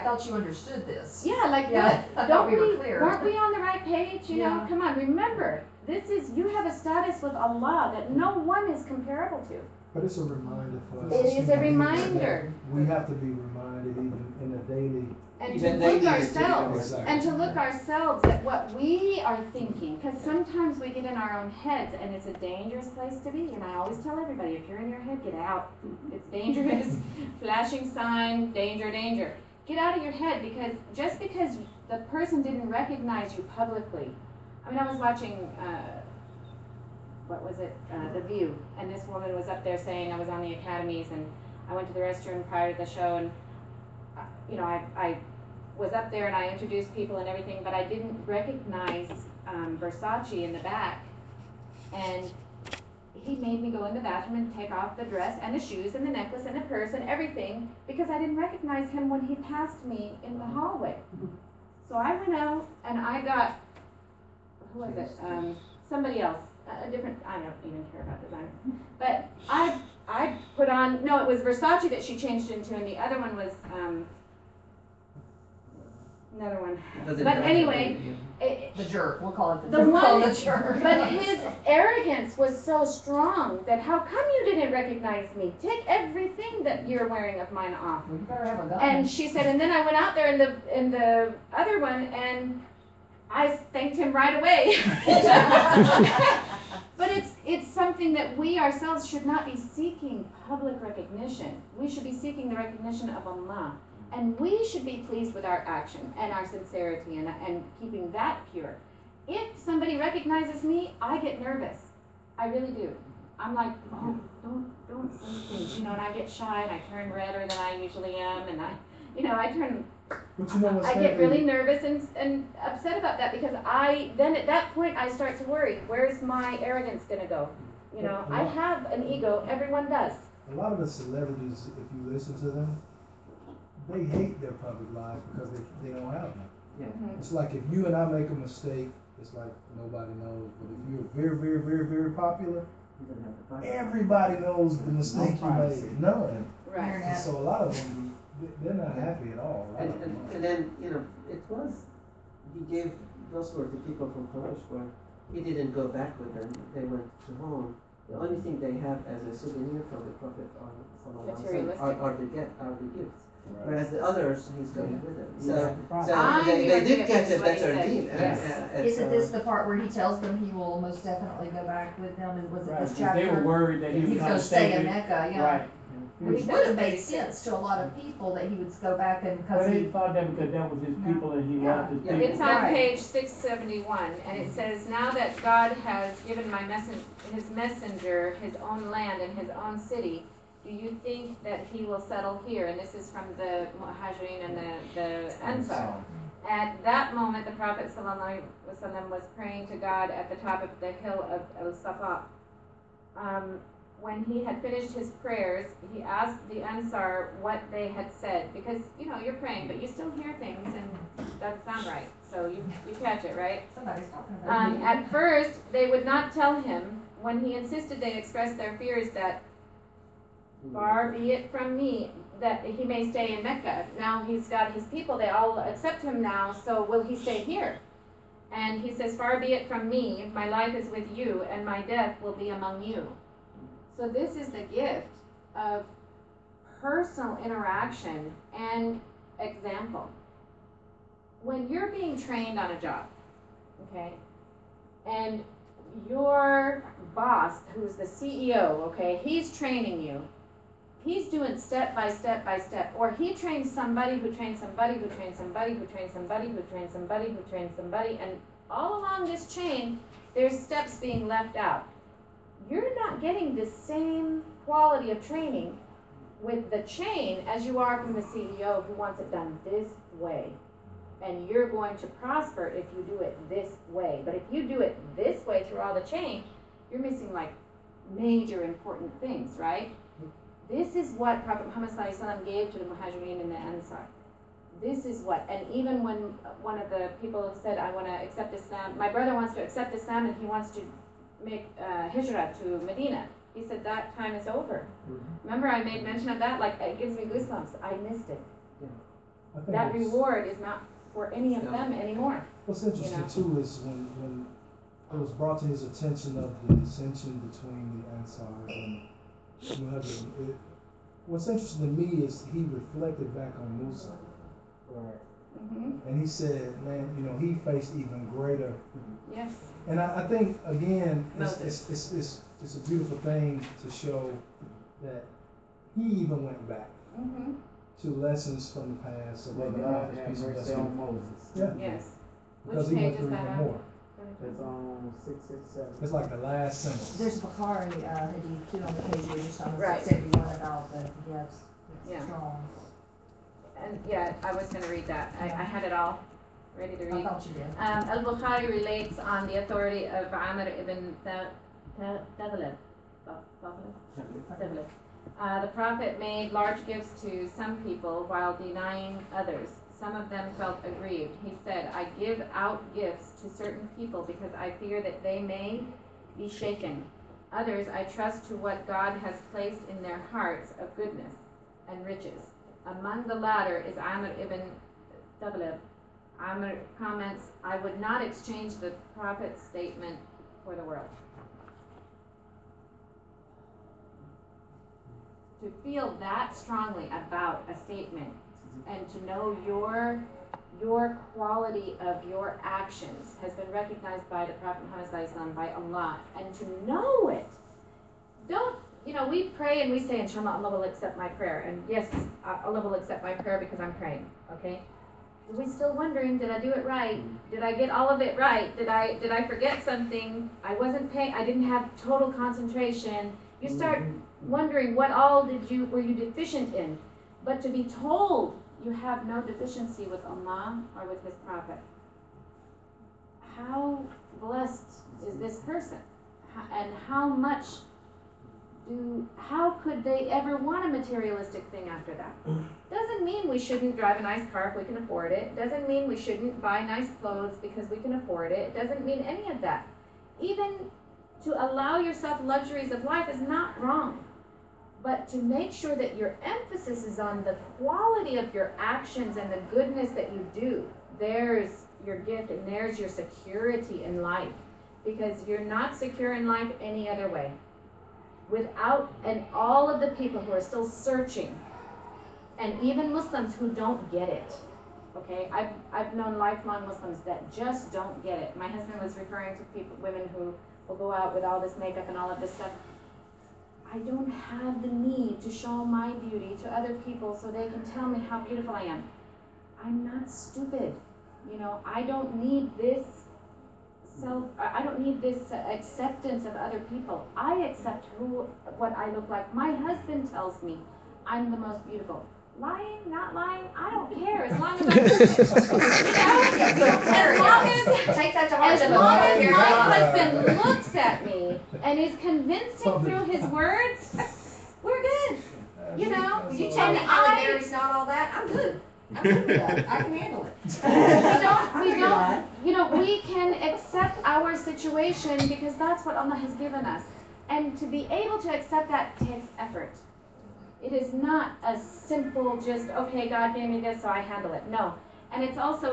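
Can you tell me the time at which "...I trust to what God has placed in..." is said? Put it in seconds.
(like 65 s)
367 s.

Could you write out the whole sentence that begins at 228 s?
And he says, Far be it from me, my life is with you, and my death will be among you.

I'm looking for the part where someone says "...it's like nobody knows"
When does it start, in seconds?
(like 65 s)
139 s.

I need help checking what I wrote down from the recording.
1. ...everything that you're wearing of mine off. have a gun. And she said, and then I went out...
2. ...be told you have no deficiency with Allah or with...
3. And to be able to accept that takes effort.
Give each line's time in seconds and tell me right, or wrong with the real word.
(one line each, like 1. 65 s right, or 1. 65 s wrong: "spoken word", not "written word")
1. 85 s right
2. 417 s right
3. 517 s right.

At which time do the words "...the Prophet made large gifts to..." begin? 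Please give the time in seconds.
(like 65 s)
355 s.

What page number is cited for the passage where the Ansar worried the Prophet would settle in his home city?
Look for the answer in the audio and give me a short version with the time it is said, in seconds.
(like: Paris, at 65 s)
671, at 183 s.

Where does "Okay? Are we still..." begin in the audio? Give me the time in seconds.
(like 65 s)
404 s.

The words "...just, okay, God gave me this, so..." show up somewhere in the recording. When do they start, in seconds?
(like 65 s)
522 s.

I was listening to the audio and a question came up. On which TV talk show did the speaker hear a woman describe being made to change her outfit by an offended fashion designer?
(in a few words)
The View.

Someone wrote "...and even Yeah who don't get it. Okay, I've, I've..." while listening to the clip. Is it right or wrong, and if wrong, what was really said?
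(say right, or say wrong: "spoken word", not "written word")
wrong: "Muslims", not "Yeah".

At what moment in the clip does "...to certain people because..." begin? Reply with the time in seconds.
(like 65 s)
363 s.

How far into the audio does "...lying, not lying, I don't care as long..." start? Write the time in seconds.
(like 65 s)
492 s.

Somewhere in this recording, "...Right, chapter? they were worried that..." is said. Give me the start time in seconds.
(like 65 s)
172 s.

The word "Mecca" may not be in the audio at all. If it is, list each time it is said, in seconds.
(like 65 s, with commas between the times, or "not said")
174 s, 223 s.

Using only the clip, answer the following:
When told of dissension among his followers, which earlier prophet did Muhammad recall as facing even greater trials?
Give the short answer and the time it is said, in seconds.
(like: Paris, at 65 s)
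Musa, at 313 s.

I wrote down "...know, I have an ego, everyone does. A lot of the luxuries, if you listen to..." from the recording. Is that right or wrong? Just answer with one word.
wrong.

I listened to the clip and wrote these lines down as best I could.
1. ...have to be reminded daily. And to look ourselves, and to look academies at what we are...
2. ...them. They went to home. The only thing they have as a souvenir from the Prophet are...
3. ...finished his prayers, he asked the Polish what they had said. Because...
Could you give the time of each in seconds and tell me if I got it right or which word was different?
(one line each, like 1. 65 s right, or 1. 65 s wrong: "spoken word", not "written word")
1. 12 s wrong: "ourselves", not "academies"
2. 156 s right
3. 204 s wrong: "Ansar", not "Polish".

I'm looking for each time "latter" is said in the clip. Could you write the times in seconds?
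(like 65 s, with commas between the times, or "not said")
373 s.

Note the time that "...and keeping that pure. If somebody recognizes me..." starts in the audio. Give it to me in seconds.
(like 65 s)
107 s.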